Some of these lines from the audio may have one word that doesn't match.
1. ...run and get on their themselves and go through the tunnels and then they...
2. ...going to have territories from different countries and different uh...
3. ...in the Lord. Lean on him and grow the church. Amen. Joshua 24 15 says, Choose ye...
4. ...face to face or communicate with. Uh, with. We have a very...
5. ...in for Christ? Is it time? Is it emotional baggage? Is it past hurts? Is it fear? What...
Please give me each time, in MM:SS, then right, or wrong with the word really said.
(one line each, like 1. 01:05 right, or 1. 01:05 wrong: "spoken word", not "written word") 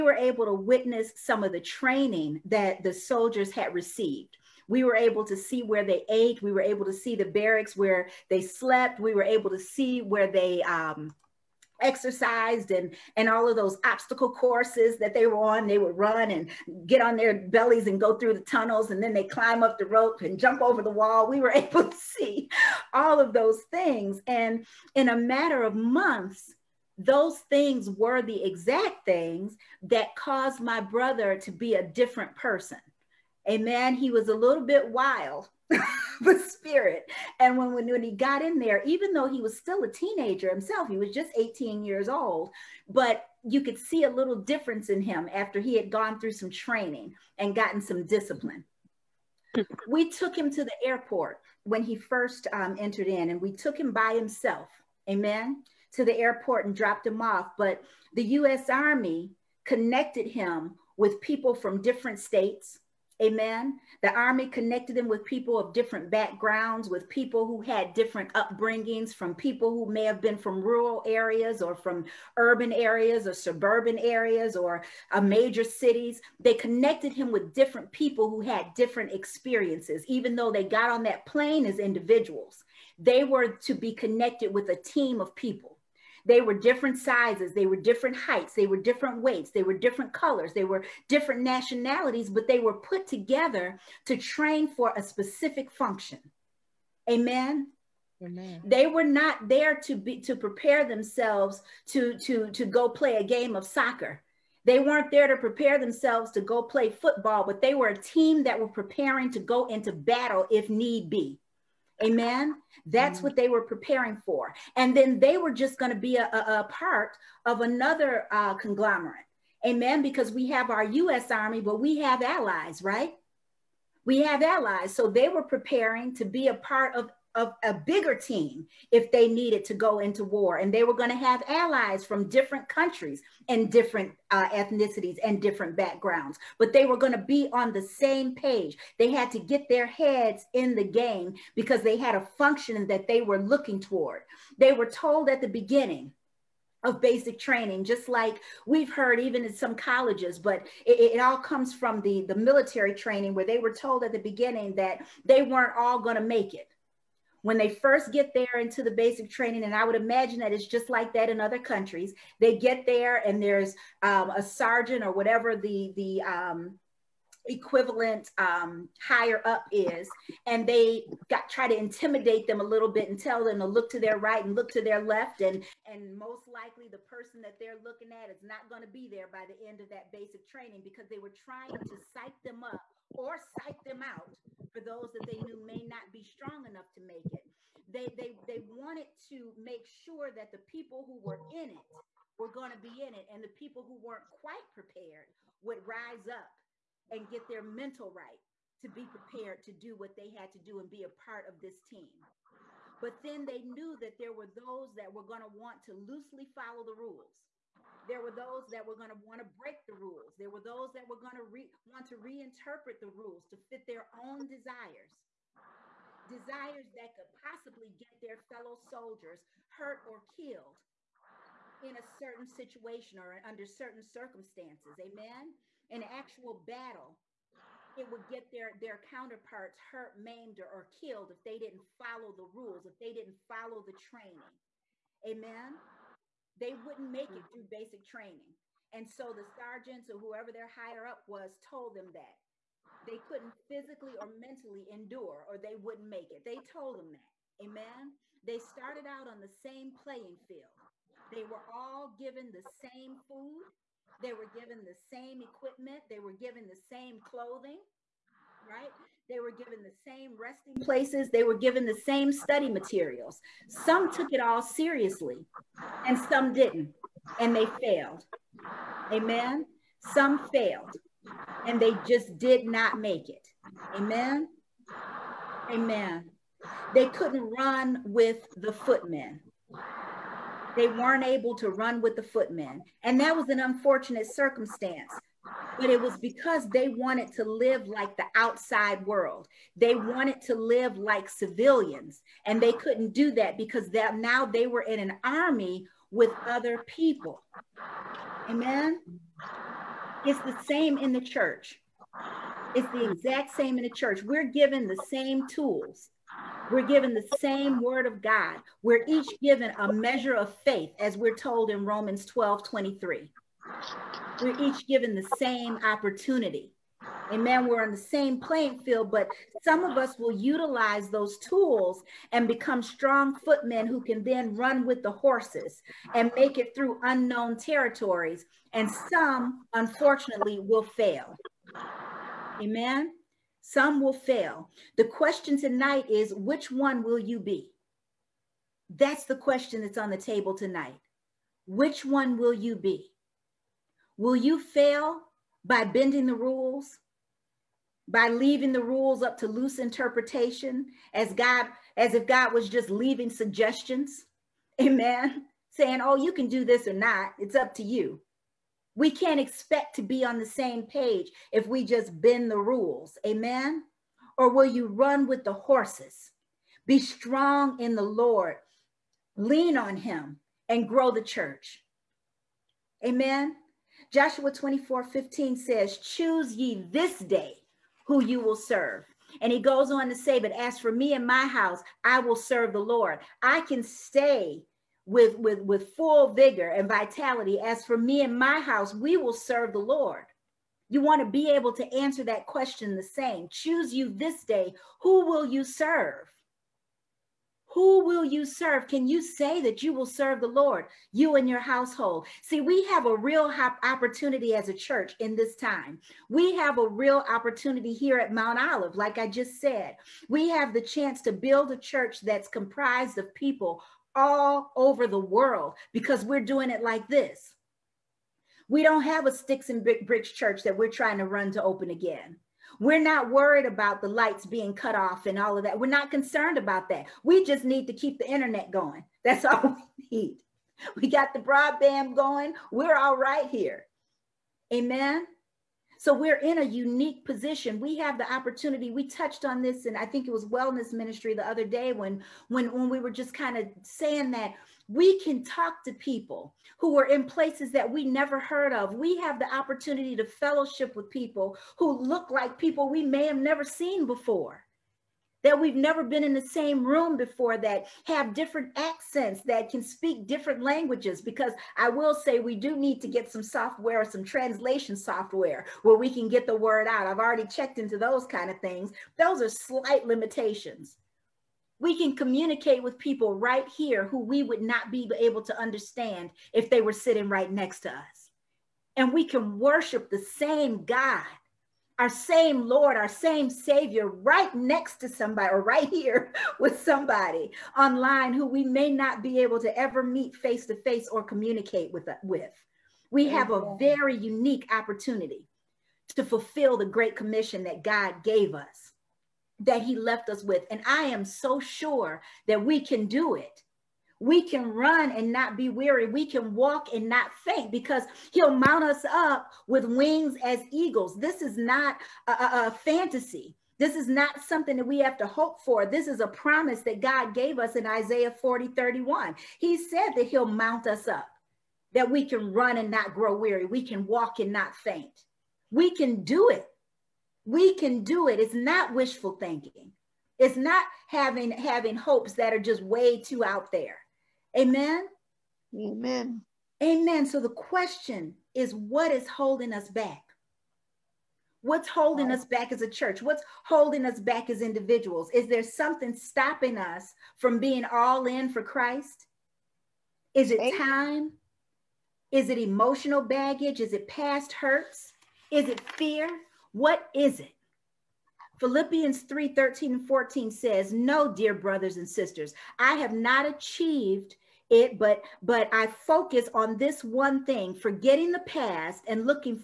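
1. 00:15 wrong: "bellies", not "themselves"
2. 02:10 wrong: "allies", not "territories"
3. 06:07 right
4. 08:10 right
5. 09:08 right.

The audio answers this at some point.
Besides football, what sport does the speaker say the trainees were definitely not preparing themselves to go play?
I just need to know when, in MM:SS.
01:43.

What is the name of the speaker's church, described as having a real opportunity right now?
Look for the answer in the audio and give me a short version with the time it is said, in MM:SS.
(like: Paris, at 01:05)
Mount Olive, at 06:48.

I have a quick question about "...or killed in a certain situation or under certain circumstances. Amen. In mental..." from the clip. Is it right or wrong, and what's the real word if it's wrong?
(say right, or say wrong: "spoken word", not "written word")
wrong: "actual", not "mental".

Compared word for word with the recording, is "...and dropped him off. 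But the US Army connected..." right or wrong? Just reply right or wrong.
right.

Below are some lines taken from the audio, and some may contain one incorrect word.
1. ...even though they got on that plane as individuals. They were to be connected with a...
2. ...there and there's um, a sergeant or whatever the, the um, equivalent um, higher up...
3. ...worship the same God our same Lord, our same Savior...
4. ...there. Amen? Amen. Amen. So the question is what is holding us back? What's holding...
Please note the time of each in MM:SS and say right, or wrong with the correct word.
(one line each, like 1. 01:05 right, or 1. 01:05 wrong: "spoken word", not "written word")
1. 01:20 right
2. 02:42 right
3. 07:59 right
4. 08:53 right.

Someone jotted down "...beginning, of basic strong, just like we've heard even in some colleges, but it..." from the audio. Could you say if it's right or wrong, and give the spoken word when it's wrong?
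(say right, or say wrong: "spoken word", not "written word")
wrong: "training", not "strong".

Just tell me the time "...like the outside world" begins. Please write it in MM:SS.
04:47.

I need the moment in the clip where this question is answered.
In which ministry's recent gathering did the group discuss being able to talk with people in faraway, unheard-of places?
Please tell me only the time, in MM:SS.
07:20.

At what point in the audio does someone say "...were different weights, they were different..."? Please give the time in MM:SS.
01:28.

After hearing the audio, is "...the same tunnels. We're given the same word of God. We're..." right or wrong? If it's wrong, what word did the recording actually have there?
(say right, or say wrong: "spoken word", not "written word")
wrong: "tools", not "tunnels".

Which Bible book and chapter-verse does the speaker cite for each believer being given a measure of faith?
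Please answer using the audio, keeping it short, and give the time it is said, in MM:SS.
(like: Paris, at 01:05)
Romans 12:23, at 05:11.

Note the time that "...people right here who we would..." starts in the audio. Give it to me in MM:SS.
07:52.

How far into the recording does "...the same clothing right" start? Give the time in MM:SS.
04:16.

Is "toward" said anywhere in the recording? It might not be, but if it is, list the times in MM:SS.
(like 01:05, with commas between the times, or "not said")
02:23.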